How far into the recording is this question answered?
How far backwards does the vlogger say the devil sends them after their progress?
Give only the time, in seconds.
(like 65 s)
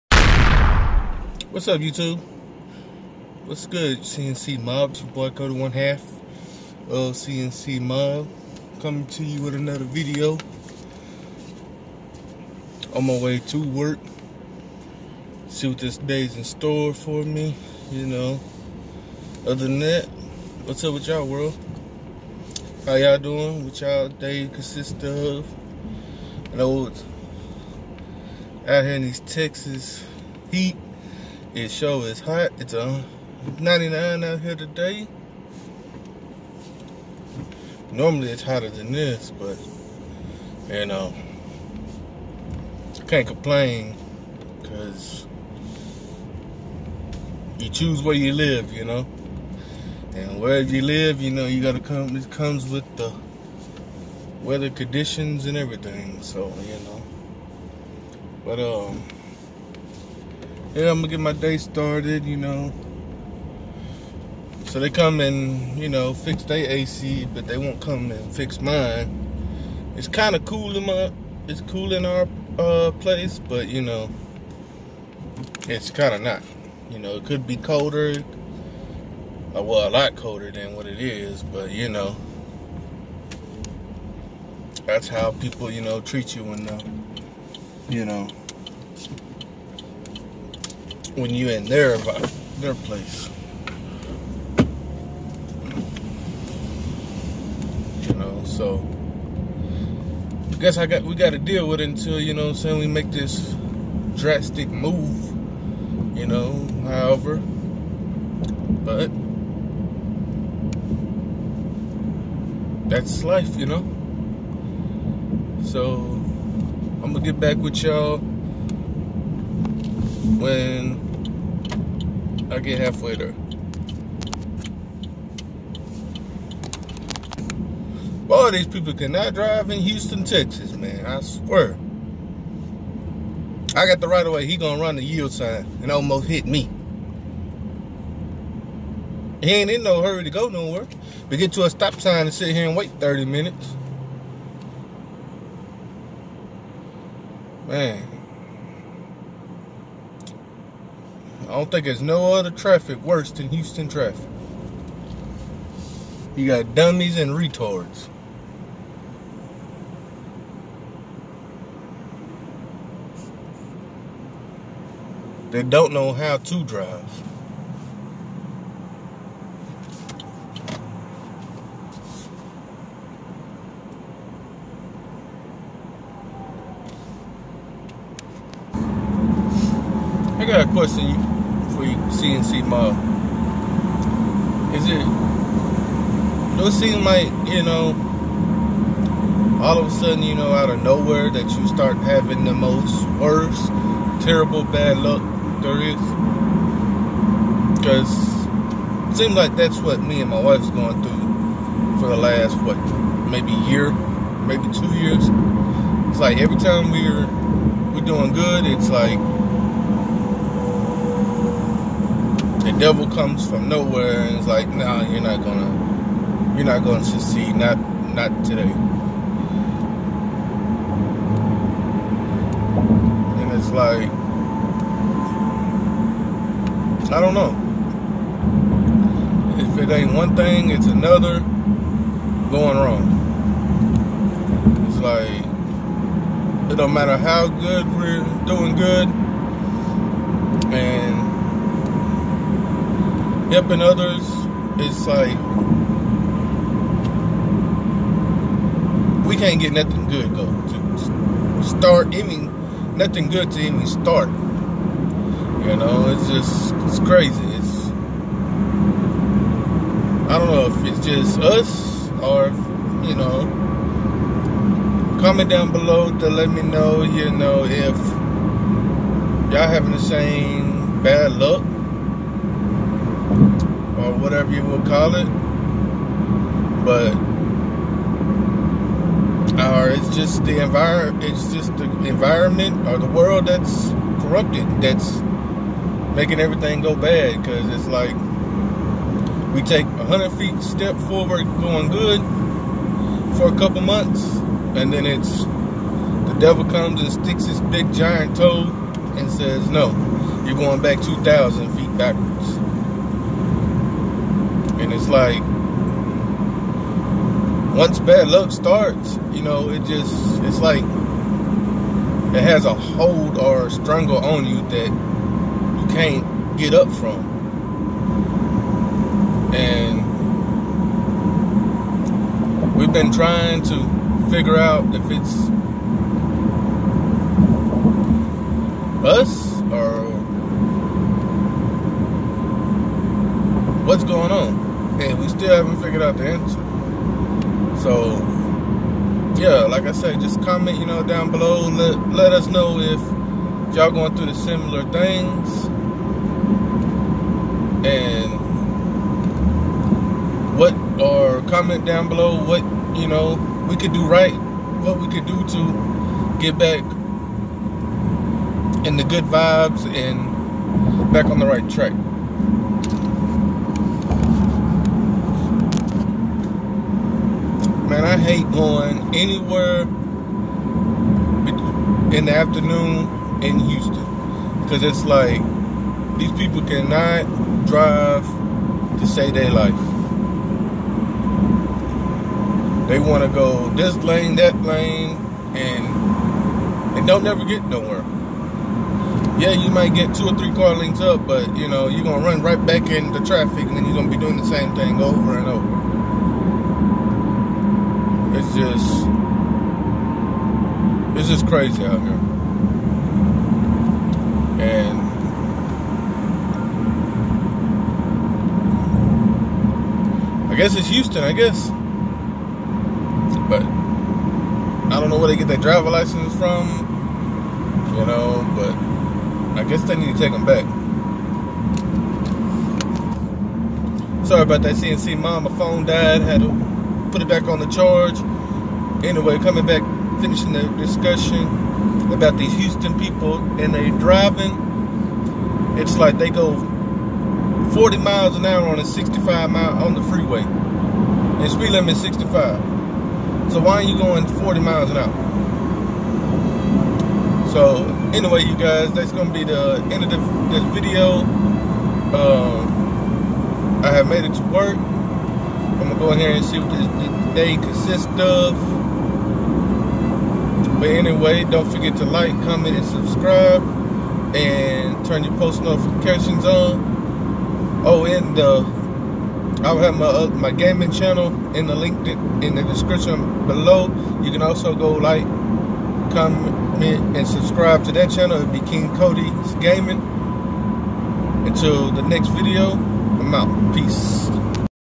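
301 s.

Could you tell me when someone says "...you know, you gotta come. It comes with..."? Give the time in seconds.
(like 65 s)
51 s.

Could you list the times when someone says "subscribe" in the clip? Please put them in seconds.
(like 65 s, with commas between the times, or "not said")
462 s, 477 s.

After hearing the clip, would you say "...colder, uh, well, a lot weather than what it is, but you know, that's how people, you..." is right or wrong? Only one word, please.
wrong.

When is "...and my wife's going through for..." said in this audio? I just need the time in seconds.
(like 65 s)
200 s.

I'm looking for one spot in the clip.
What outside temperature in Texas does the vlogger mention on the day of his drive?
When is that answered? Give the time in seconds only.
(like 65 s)
33 s.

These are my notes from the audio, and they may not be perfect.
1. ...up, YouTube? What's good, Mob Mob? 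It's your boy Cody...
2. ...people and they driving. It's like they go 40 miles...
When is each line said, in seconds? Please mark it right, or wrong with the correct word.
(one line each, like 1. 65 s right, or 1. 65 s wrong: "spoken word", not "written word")
1. 1 s wrong: "CNC", not "Mob"
2. 432 s right.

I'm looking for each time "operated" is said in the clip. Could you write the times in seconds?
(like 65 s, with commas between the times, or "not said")
not said.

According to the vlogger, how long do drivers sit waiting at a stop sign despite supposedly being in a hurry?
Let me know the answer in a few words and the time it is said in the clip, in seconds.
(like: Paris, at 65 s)
30 minutes, at 142 s.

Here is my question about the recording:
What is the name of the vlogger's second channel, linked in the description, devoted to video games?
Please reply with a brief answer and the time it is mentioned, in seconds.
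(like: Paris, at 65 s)
King Cody's Gaming, at 478 s.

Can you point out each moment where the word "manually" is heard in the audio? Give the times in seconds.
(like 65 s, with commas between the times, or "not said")
not said.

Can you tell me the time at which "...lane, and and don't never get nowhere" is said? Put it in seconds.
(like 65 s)
384 s.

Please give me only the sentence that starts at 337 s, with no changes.
So, yeah, like I said, just comment, you know, down below.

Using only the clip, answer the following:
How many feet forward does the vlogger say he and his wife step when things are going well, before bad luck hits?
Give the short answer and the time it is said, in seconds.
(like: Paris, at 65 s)
100 feet, at 289 s.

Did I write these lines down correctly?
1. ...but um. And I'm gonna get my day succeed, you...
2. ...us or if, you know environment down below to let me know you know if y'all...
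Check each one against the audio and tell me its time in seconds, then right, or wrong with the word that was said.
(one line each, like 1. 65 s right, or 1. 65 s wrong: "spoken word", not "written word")
1. 58 s wrong: "started", not "succeed"
2. 261 s wrong: "comment", not "environment".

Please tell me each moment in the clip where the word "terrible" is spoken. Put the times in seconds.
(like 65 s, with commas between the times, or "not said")
194 s.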